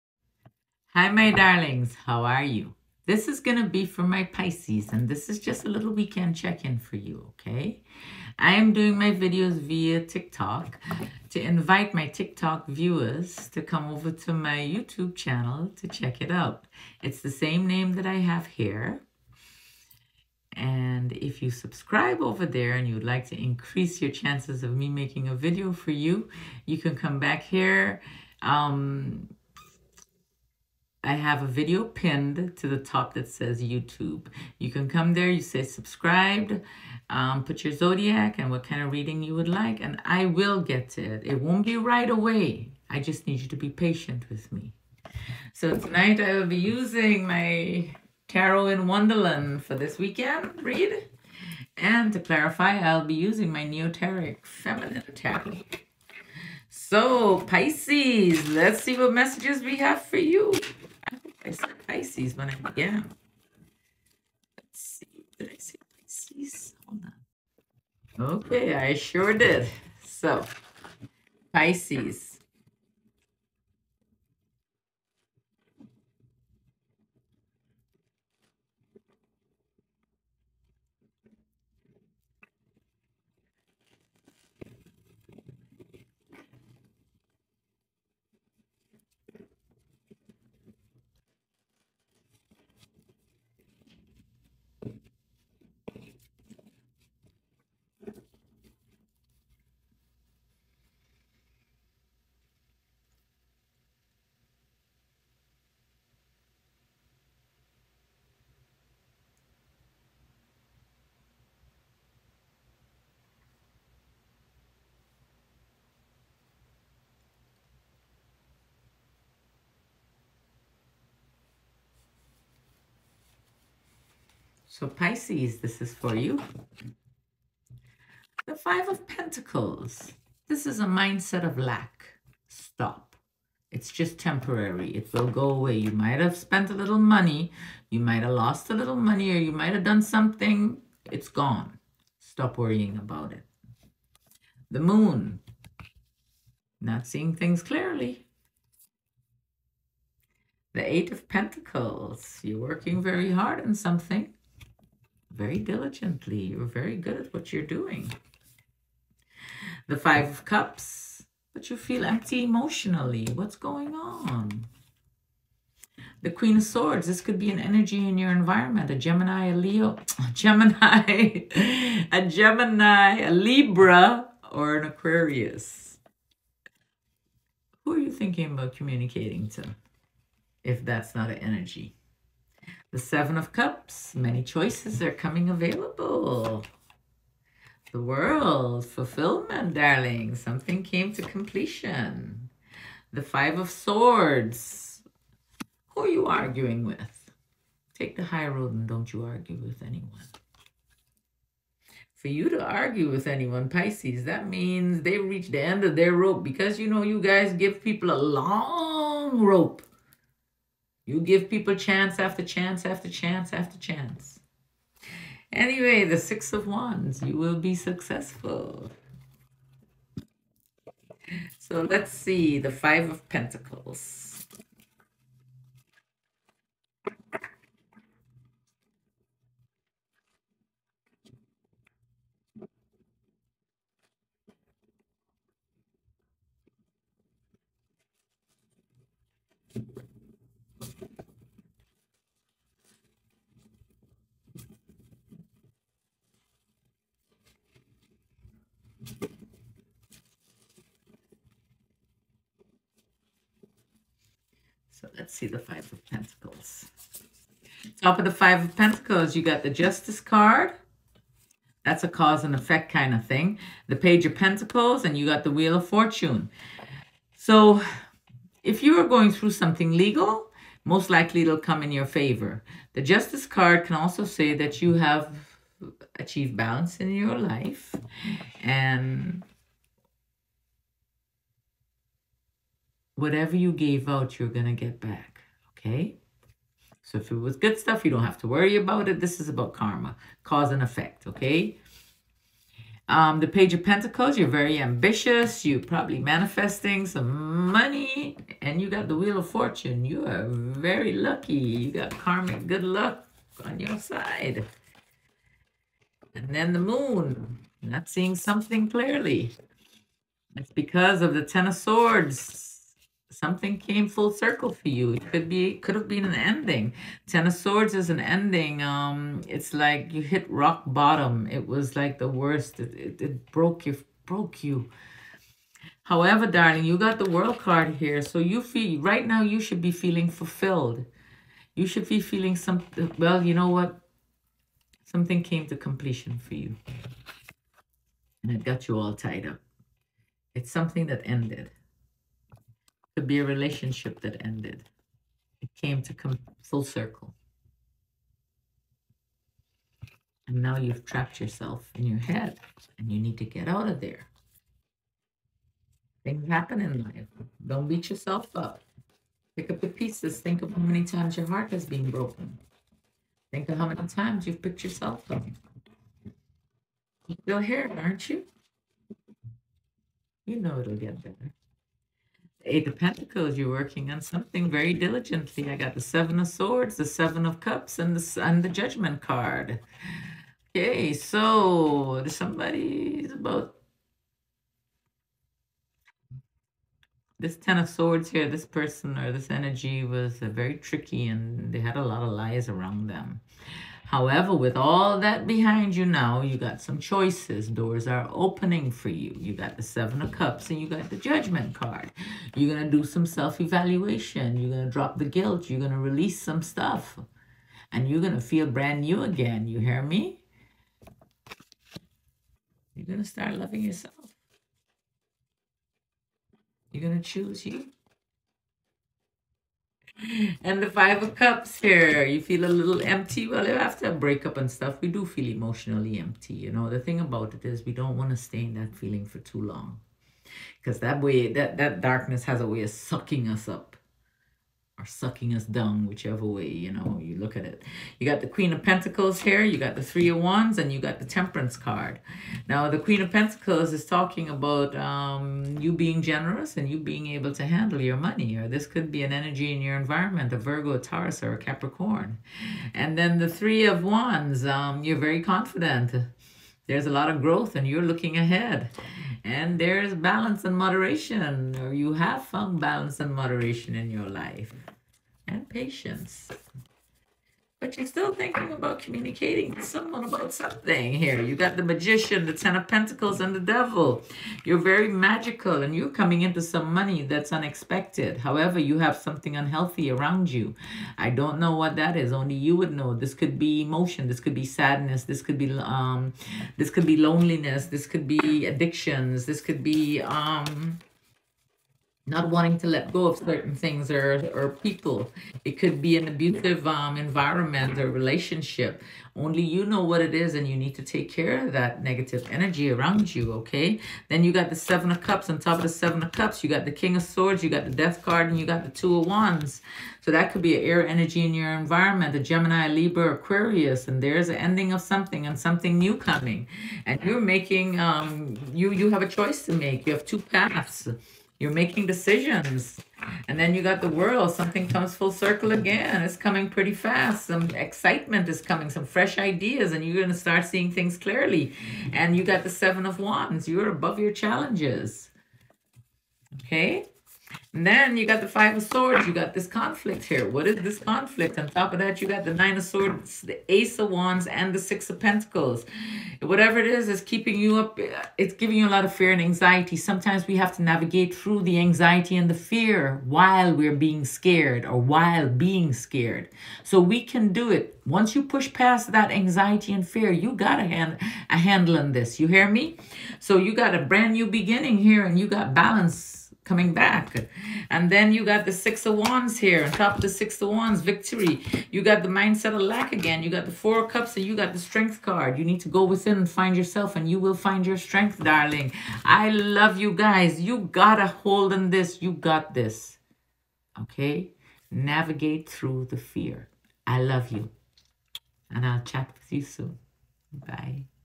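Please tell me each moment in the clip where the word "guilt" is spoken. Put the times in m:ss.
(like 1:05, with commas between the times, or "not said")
6:45.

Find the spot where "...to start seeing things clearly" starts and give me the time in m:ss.
8:50.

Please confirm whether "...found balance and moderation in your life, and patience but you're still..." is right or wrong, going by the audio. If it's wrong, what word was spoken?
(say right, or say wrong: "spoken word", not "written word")
right.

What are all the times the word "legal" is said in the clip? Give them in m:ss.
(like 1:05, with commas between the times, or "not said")
4:29.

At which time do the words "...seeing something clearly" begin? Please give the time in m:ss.
5:08.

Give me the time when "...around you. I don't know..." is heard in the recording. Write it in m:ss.
8:00.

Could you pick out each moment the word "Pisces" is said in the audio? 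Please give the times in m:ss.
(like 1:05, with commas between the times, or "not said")
0:04, 0:57, 1:01, 1:05, 1:11, 2:04, 3:23.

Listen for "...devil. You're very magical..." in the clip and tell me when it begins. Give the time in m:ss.
7:53.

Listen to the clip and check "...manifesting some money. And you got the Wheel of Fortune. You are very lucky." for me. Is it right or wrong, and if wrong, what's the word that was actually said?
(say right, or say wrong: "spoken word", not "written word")
right.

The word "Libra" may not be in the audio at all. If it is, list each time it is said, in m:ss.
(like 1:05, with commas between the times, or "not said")
2:53, 8:32.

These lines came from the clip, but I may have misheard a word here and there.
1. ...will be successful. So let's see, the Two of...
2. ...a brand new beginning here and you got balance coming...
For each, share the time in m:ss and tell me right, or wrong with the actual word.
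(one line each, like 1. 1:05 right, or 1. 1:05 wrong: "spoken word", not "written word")
1. 3:37 wrong: "Five", not "Two"
2. 9:23 right.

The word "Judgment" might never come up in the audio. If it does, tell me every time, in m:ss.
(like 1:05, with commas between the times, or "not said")
6:18, 6:41.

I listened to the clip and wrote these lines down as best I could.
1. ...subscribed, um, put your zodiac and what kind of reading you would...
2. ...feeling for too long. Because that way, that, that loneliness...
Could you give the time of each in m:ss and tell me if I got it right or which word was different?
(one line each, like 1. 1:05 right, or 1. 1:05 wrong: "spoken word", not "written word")
1. 0:35 right
2. 7:08 wrong: "darkness", not "loneliness".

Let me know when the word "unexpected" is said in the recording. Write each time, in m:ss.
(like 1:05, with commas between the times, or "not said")
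7:57.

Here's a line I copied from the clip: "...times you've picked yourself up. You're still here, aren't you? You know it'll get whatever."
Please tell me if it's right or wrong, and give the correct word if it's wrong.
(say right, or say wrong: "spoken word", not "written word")
wrong: "better", not "whatever".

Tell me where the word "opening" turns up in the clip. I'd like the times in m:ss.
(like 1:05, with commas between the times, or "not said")
6:38.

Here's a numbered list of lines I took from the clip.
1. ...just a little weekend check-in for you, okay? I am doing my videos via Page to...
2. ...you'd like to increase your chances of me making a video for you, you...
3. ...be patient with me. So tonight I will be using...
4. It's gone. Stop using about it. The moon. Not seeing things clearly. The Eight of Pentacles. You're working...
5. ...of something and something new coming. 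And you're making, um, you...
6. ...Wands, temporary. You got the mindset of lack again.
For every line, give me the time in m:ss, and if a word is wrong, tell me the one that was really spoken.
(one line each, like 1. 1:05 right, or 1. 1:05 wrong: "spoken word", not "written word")
1. 0:05 wrong: "TikTok", not "Page"
2. 0:22 right
3. 0:43 right
4. 2:21 wrong: "worrying", not "using"
5. 8:34 right
6. 9:30 wrong: "victory", not "temporary".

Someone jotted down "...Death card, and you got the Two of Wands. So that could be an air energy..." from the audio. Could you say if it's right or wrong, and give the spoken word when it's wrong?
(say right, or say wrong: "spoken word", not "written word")
right.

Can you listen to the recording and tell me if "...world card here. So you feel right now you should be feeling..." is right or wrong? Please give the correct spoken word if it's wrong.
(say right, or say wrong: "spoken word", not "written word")
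right.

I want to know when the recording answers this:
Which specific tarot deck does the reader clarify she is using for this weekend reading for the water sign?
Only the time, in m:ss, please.
0:53.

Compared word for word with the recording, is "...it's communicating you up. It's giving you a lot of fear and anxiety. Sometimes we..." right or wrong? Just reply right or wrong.
wrong.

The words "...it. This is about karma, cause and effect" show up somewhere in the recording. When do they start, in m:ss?
4:49.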